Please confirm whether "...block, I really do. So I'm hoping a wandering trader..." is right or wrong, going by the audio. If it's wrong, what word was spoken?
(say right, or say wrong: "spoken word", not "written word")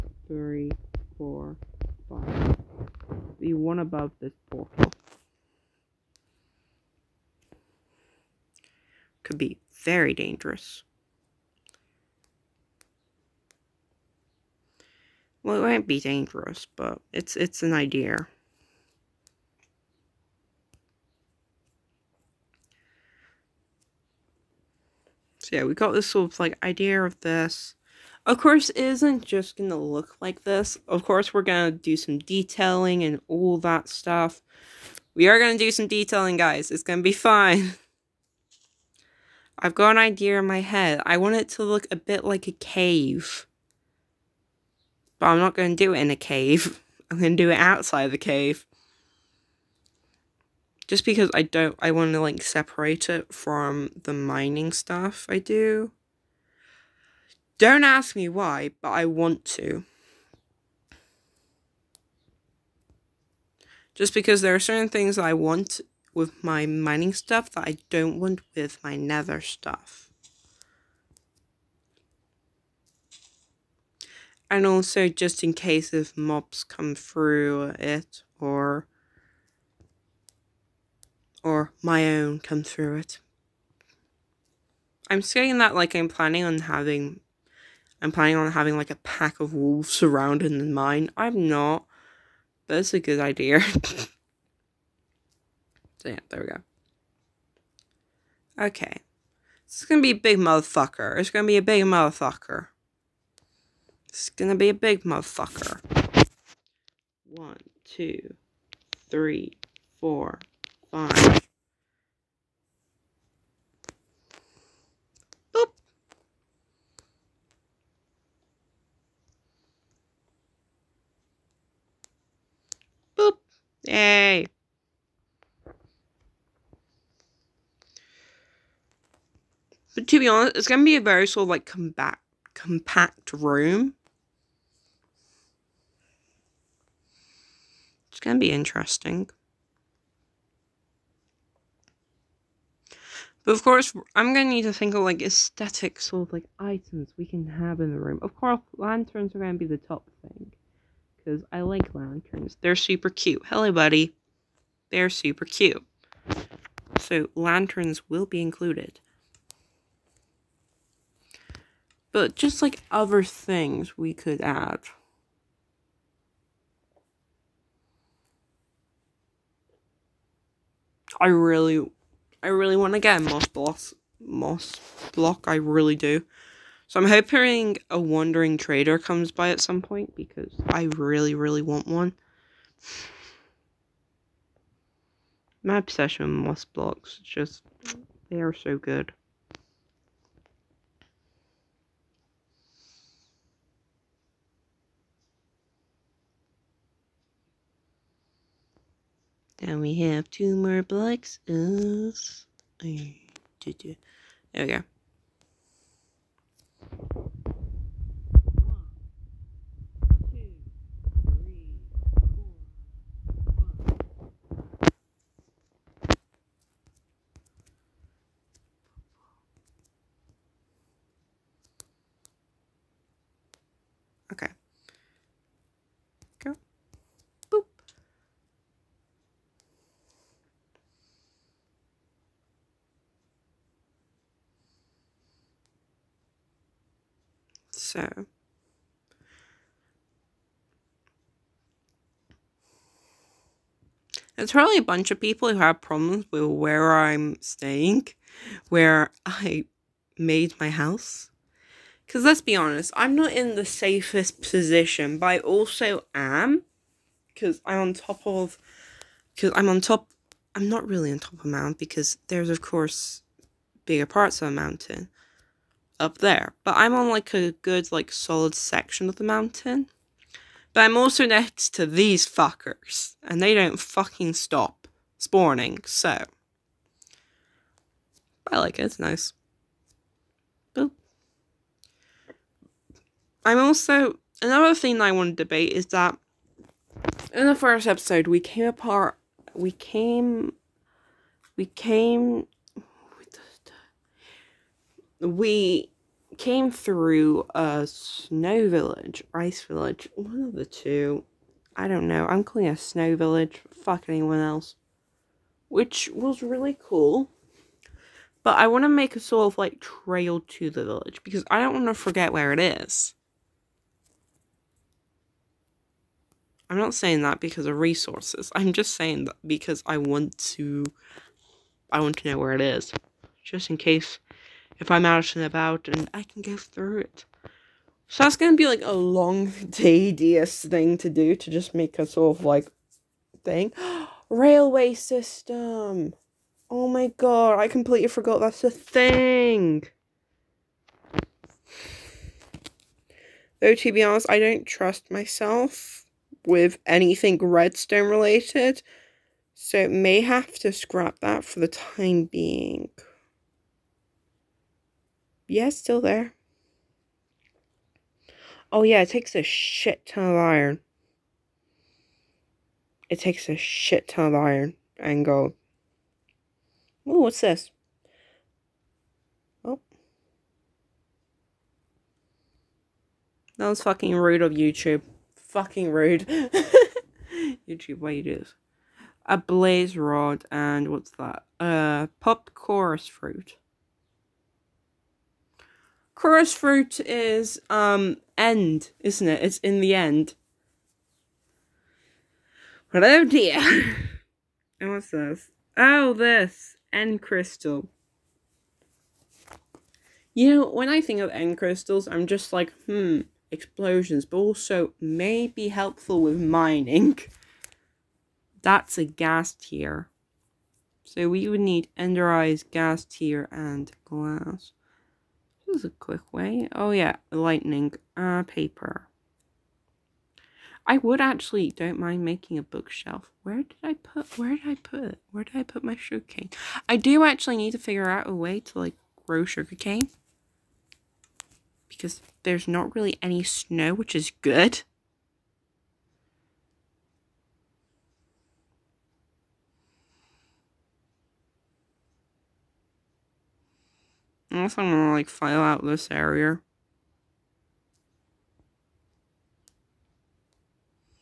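right.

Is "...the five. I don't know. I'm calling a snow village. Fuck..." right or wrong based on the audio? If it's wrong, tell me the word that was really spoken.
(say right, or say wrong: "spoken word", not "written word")
wrong: "two", not "five".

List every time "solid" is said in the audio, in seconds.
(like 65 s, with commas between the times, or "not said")
268 s.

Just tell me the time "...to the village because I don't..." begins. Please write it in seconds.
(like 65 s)
310 s.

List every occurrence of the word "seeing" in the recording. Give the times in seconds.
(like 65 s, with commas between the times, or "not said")
not said.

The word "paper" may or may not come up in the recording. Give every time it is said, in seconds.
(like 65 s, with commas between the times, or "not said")
418 s.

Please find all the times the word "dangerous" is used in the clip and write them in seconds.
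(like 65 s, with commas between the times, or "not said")
10 s, 16 s.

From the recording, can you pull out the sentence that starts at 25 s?
So yeah, we got this sort of like idea of this.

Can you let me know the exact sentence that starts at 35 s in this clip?
We are gonna do some detailing, guys.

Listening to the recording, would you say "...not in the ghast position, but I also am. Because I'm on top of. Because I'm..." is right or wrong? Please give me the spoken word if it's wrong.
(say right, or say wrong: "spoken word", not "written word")
wrong: "safest", not "ghast".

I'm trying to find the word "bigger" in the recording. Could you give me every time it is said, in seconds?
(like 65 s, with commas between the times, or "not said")
263 s.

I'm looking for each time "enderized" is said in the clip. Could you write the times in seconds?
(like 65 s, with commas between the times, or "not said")
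411 s.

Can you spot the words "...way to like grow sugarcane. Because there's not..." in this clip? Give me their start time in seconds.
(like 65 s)
428 s.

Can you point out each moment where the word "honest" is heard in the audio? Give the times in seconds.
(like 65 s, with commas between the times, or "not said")
130 s, 252 s, 344 s.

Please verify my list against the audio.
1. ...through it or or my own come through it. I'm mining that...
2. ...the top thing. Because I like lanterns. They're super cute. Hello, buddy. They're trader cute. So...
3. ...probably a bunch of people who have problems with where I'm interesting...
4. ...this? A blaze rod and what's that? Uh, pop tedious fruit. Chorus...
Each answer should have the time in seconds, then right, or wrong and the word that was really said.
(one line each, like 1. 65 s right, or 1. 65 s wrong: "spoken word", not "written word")
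1. 76 s wrong: "saying", not "mining"
2. 149 s wrong: "super", not "trader"
3. 244 s wrong: "staying", not "interesting"
4. 378 s wrong: "chorus", not "tedious".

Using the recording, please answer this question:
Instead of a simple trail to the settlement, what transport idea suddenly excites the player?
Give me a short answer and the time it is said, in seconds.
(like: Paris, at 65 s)
Railway system, at 334 s.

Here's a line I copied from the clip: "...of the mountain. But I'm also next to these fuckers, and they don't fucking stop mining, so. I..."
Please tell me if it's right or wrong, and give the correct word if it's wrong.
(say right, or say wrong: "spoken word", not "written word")
wrong: "spawning", not "mining".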